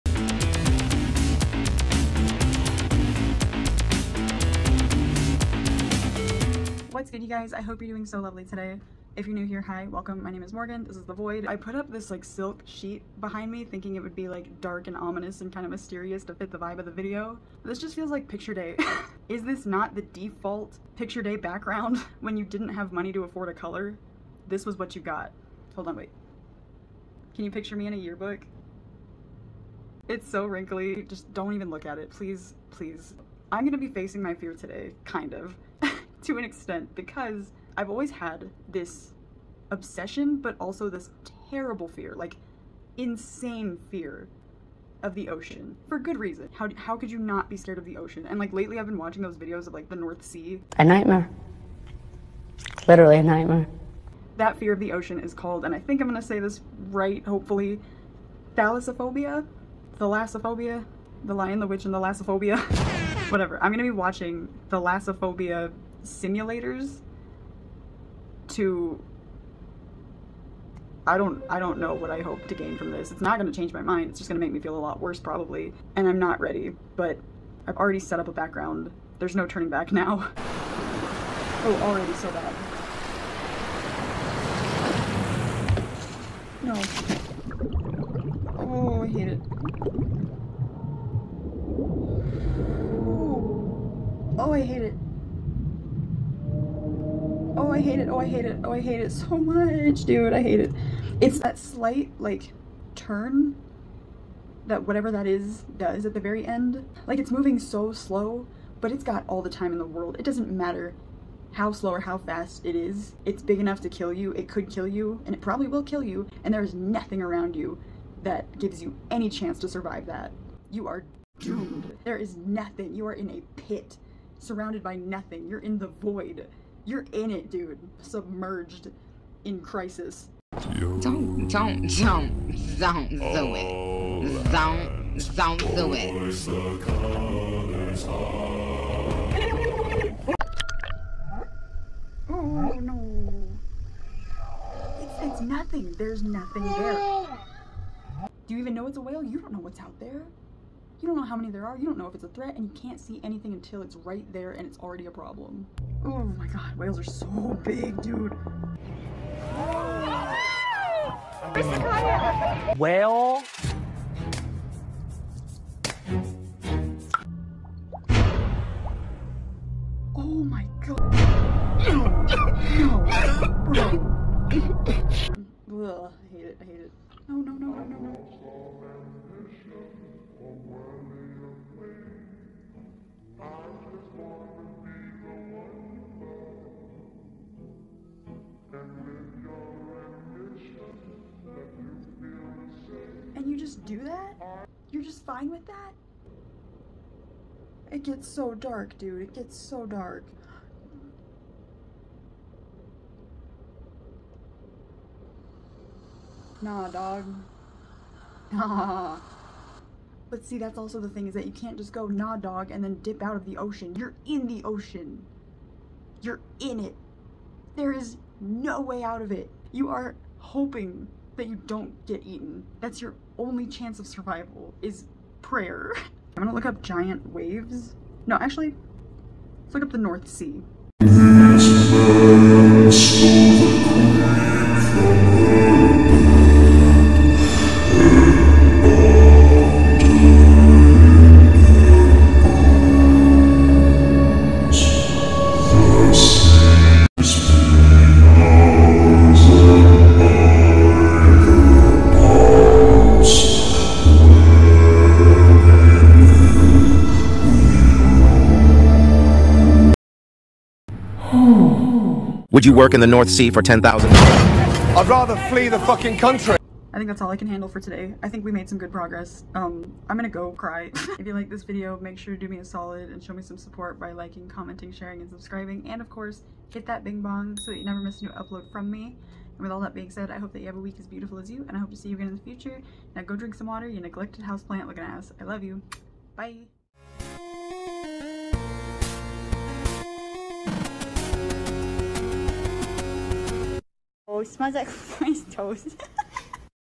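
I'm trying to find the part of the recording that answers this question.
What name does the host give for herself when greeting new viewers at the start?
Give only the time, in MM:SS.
00:10.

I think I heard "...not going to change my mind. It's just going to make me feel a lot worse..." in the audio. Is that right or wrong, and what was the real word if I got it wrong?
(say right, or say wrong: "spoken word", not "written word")
right.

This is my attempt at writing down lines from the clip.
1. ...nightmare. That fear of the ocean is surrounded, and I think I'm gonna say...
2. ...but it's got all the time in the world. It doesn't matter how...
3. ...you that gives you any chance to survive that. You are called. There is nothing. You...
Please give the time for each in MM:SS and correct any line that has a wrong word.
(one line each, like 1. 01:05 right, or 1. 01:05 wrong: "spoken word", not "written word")
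1. 00:53 wrong: "called", not "surrounded"
2. 01:48 right
3. 01:57 wrong: "doomed", not "called".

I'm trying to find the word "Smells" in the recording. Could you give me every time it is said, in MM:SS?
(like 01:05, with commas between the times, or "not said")
04:54.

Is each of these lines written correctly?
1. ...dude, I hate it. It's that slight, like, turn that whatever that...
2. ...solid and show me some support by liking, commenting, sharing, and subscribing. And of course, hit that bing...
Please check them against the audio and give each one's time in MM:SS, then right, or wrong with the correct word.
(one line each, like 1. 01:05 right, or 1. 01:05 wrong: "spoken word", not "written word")
1. 01:40 right
2. 04:32 right.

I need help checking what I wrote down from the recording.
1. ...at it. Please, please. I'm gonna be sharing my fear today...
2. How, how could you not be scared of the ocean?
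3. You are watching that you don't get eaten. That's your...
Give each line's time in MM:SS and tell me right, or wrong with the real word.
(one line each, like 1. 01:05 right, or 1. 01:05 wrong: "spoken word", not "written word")
1. 00:31 wrong: "facing", not "sharing"
2. 00:46 right
3. 03:39 wrong: "hoping", not "watching".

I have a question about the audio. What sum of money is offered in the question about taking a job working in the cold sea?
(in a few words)
10,000.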